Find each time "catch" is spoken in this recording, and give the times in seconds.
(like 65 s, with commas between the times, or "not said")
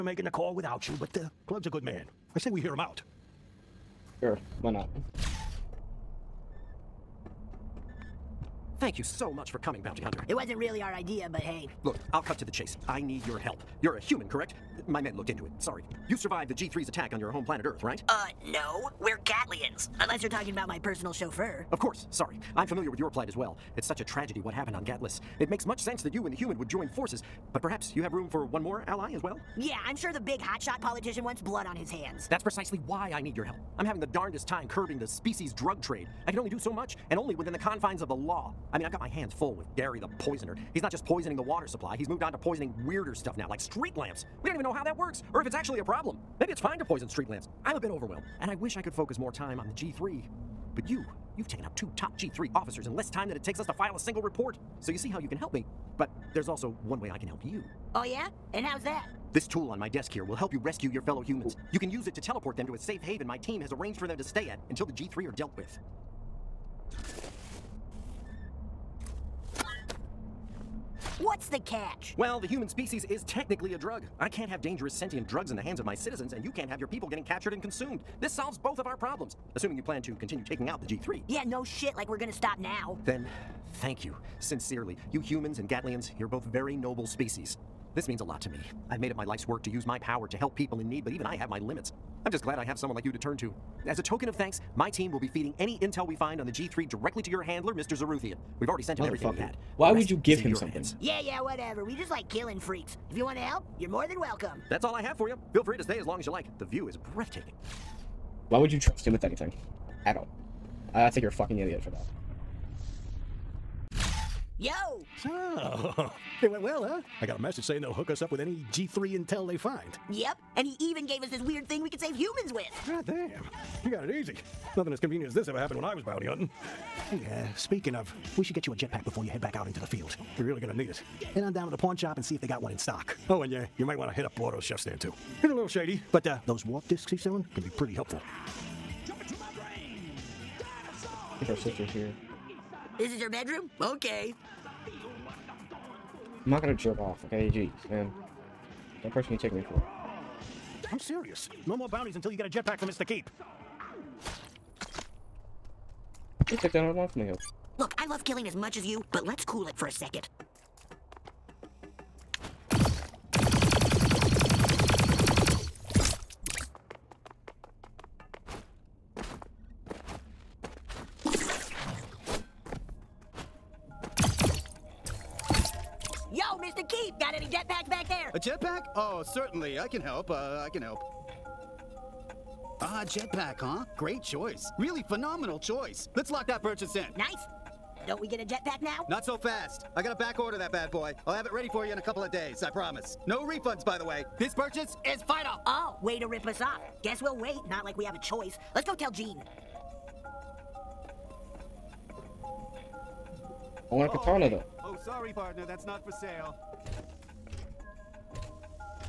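71 s.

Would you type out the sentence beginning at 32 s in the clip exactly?
That's precisely why I need your help.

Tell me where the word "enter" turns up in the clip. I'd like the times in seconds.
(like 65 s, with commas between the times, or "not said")
not said.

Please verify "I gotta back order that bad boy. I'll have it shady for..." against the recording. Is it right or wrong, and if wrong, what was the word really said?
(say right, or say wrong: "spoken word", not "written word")
wrong: "ready", not "shady".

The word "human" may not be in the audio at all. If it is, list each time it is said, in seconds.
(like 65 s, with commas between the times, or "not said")
13 s, 26 s, 61 s, 72 s, 85 s, 122 s.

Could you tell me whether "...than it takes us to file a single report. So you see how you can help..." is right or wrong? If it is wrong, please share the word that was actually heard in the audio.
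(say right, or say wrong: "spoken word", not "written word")
right.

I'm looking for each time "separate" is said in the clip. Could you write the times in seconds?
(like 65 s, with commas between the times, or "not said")
not said.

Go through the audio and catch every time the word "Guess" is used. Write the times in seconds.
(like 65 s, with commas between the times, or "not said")
197 s.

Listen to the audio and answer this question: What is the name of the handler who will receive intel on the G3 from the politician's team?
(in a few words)
Mr. Zaroothian.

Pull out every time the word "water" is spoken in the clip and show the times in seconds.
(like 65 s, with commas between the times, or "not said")
41 s.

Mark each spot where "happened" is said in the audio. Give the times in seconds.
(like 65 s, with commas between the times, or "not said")
24 s, 125 s.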